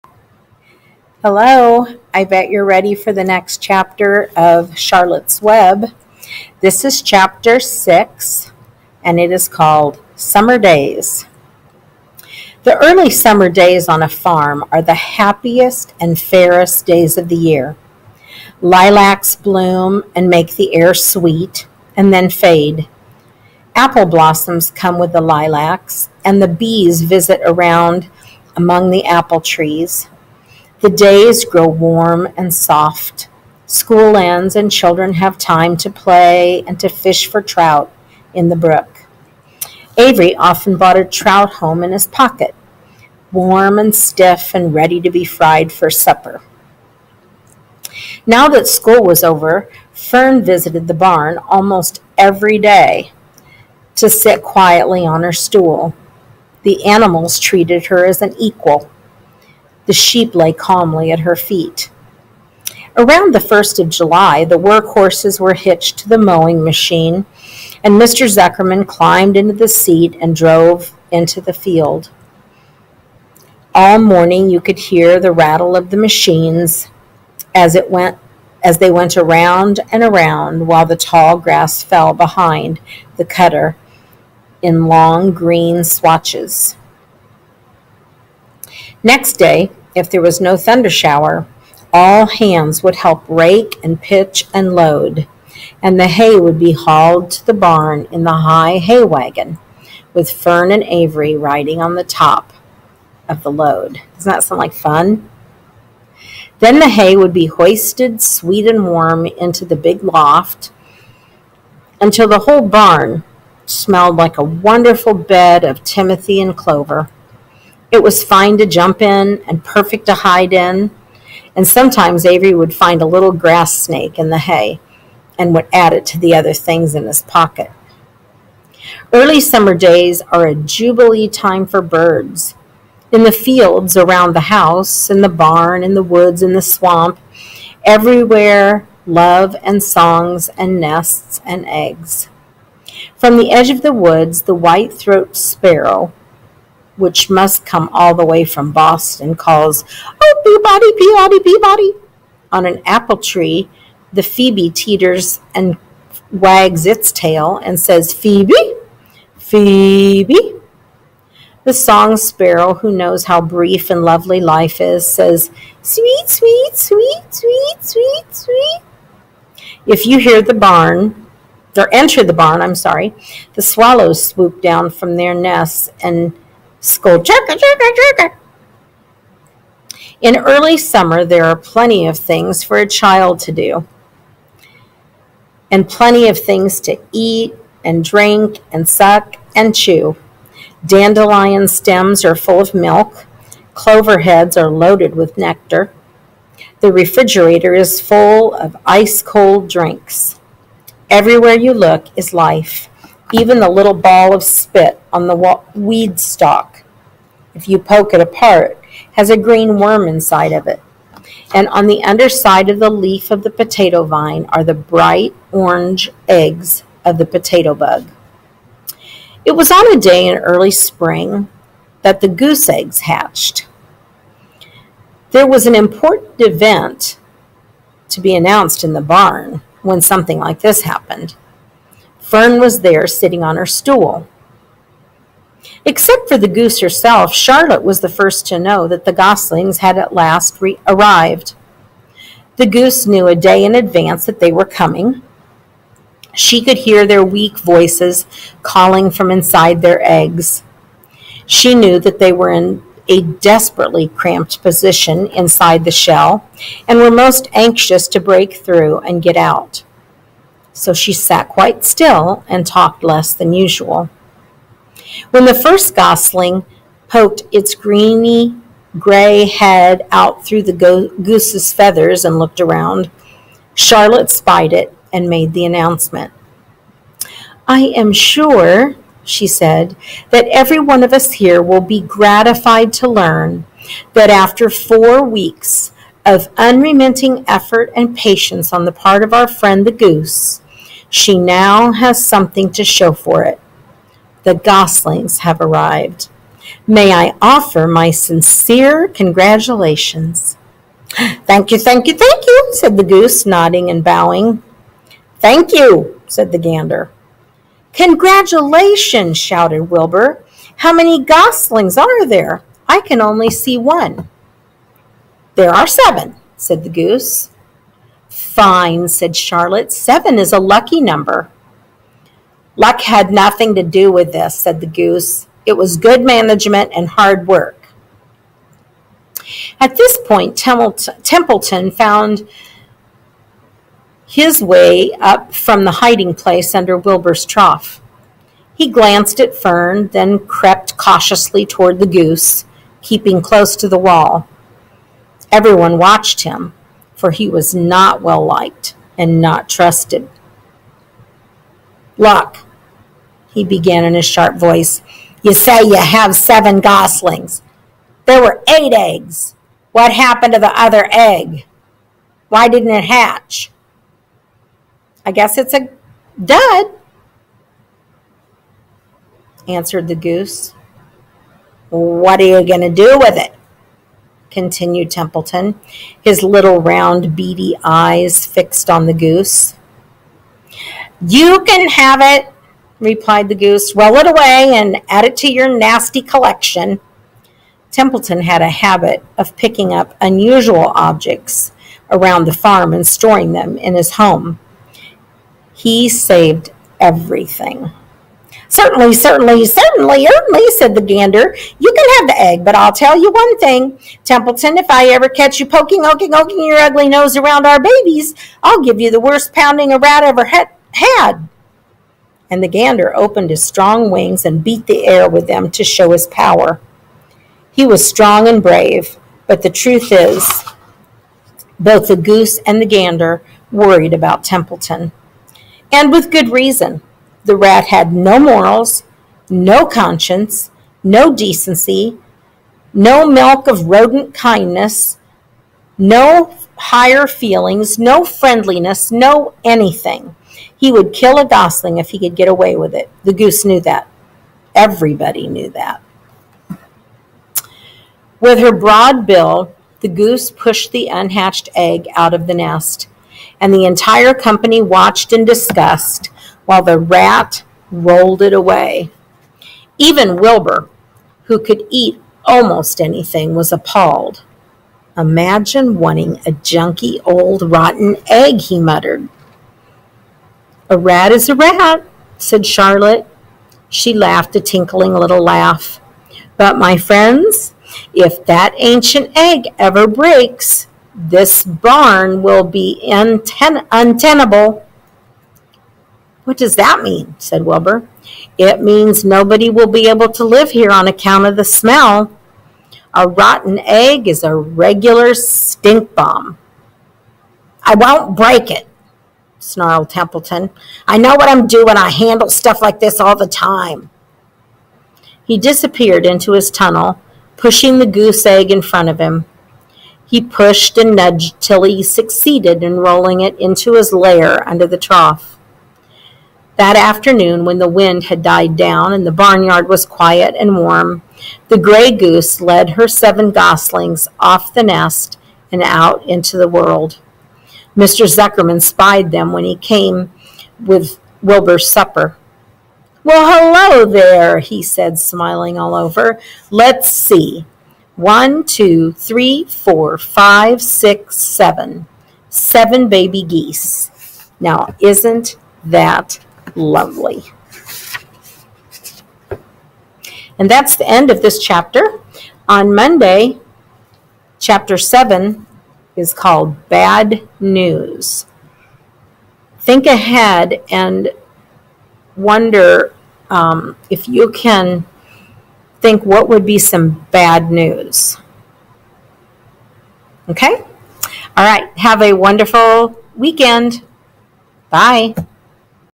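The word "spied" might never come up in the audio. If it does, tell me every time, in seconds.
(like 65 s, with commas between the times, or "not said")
274 s, 528 s.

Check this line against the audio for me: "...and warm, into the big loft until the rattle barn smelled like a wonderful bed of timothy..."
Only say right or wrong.
wrong.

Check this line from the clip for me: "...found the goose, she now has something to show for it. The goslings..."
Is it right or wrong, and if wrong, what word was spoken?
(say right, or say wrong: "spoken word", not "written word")
wrong: "friend", not "found".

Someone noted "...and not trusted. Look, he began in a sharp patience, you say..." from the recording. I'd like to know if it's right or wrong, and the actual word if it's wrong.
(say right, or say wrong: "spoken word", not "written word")
wrong: "voice", not "patience".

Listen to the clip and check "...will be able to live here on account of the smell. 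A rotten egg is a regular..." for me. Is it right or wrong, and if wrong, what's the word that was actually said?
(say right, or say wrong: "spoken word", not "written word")
right.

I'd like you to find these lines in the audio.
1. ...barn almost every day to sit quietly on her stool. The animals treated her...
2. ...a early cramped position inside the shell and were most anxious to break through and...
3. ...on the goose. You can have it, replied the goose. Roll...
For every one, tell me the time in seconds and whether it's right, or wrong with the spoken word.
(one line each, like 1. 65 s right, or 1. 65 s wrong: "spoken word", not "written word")
1. 50 s right
2. 253 s wrong: "desperately", not "early"
3. 378 s right.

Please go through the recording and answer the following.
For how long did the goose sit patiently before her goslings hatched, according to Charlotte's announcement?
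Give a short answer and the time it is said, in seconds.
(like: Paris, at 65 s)
4 weeks, at 284 s.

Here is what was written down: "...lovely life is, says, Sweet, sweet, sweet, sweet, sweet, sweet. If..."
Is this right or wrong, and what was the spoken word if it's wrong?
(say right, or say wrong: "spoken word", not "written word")
right.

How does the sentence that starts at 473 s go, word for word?
She laughed a tinkling little laugh.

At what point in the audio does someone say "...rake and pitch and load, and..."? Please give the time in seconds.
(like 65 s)
93 s.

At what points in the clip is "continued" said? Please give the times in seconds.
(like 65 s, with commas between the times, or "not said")
374 s.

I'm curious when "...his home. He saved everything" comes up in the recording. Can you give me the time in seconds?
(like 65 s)
393 s.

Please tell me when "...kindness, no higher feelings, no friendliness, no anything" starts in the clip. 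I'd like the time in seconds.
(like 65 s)
434 s.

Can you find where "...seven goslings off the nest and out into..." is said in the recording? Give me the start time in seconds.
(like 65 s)
523 s.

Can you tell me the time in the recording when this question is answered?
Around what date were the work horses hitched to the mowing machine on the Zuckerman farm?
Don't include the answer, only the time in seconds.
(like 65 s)
63 s.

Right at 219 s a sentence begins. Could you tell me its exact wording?
It was on a day in early spring that the goose eggs hatched.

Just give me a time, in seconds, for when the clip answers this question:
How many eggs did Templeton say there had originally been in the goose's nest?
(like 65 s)
358 s.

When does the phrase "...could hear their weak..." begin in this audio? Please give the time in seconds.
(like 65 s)
246 s.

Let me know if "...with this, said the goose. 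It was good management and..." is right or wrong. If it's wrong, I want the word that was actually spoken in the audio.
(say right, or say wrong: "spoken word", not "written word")
right.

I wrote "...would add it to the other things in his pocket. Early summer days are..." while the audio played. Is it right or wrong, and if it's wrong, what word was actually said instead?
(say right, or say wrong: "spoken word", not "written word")
right.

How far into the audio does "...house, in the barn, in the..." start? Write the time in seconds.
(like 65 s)
134 s.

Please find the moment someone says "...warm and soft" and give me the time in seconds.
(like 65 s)
31 s.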